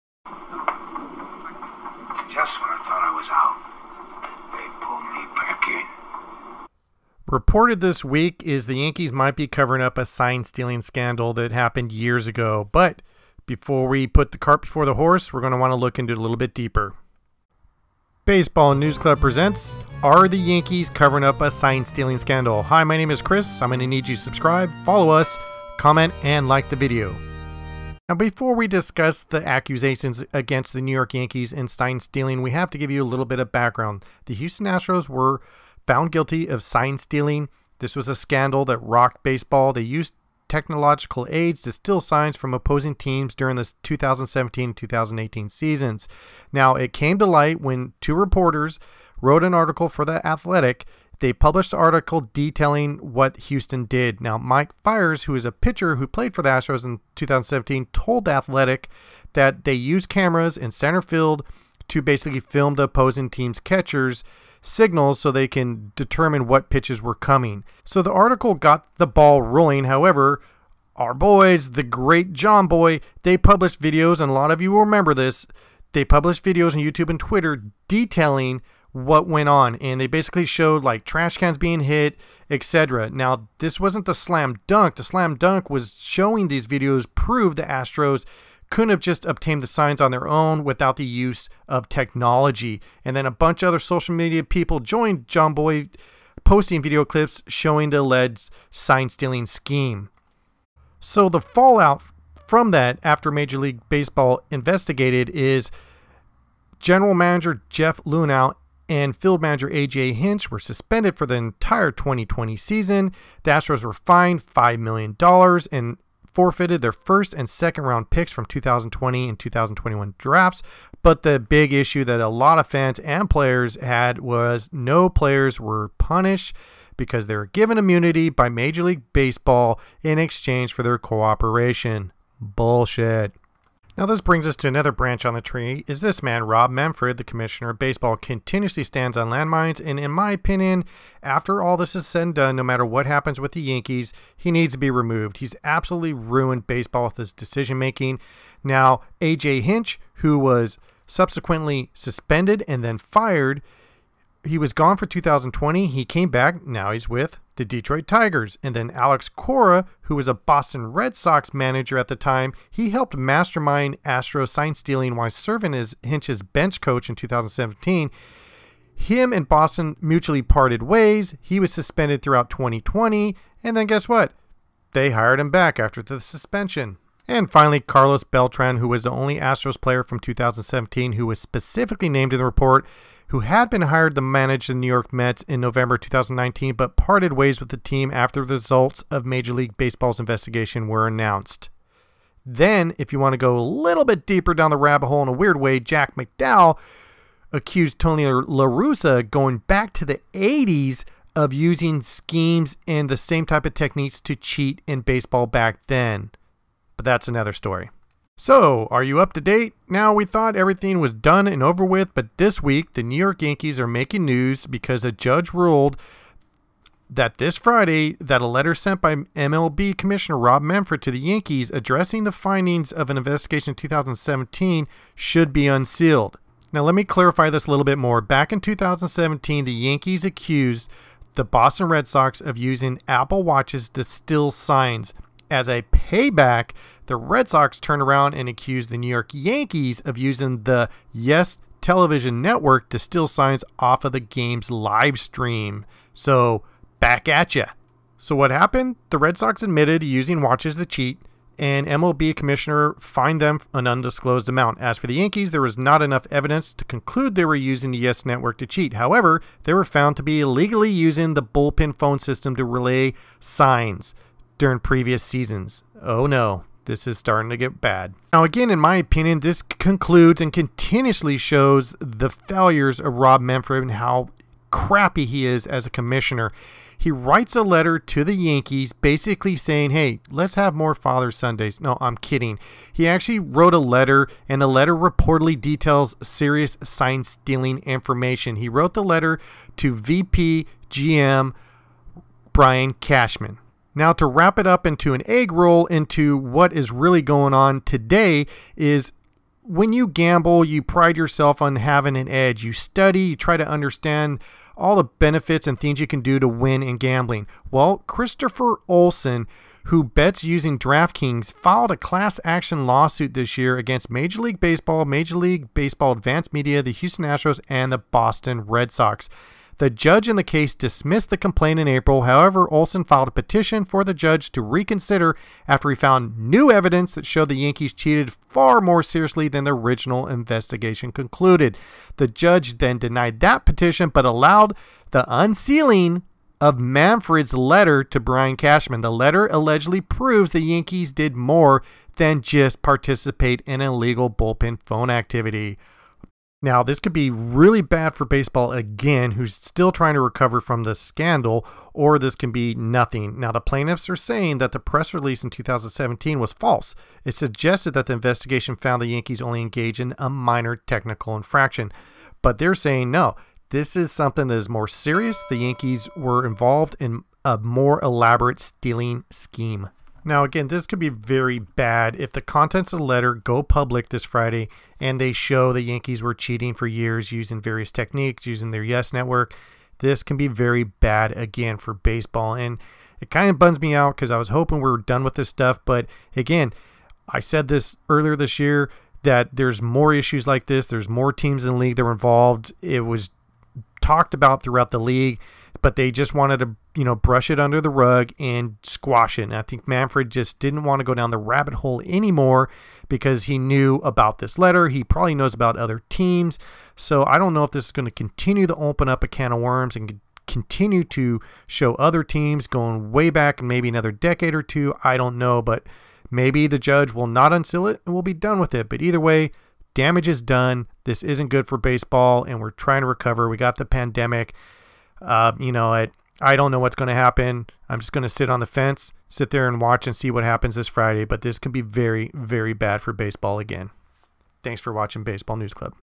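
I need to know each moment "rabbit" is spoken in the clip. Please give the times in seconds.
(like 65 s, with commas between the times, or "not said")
194 s, 401 s.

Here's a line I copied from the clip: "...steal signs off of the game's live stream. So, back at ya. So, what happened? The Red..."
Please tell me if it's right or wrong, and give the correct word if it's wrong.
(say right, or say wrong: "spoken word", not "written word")
right.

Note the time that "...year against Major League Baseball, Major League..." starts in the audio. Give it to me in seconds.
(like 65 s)
313 s.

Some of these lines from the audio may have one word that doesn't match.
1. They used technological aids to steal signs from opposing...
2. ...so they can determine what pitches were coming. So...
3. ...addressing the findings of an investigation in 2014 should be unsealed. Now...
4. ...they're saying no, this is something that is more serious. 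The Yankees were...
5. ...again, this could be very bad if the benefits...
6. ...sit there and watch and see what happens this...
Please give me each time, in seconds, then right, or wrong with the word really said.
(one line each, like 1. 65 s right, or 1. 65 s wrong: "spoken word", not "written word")
1. 39 s right
2. 65 s right
3. 221 s wrong: "2017", not "2014"
4. 362 s right
5. 370 s wrong: "contents", not "benefits"
6. 429 s right.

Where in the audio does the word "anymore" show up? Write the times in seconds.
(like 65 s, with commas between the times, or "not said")
402 s.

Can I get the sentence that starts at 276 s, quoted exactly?
He writes a letter to the Yankees basically saying, hey, let's have more Father Sundays.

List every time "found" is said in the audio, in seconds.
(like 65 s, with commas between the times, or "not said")
35 s, 259 s, 325 s, 358 s.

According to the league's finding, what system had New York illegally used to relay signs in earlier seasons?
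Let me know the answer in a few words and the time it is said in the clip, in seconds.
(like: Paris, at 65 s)
bullpen phone system, at 261 s.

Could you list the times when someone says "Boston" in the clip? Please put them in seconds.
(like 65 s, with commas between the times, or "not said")
160 s, 169 s, 231 s, 317 s.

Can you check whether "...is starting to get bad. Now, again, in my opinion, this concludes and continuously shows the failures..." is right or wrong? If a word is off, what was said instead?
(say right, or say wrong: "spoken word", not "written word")
right.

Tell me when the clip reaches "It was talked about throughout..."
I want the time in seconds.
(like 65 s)
392 s.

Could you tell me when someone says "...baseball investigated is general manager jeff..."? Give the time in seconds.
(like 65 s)
103 s.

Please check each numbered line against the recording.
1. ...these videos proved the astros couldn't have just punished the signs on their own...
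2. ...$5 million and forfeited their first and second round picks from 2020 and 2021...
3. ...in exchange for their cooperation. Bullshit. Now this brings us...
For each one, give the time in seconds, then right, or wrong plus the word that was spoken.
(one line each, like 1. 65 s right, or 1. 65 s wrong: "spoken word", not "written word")
1. 86 s wrong: "obtained", not "punished"
2. 114 s right
3. 130 s right.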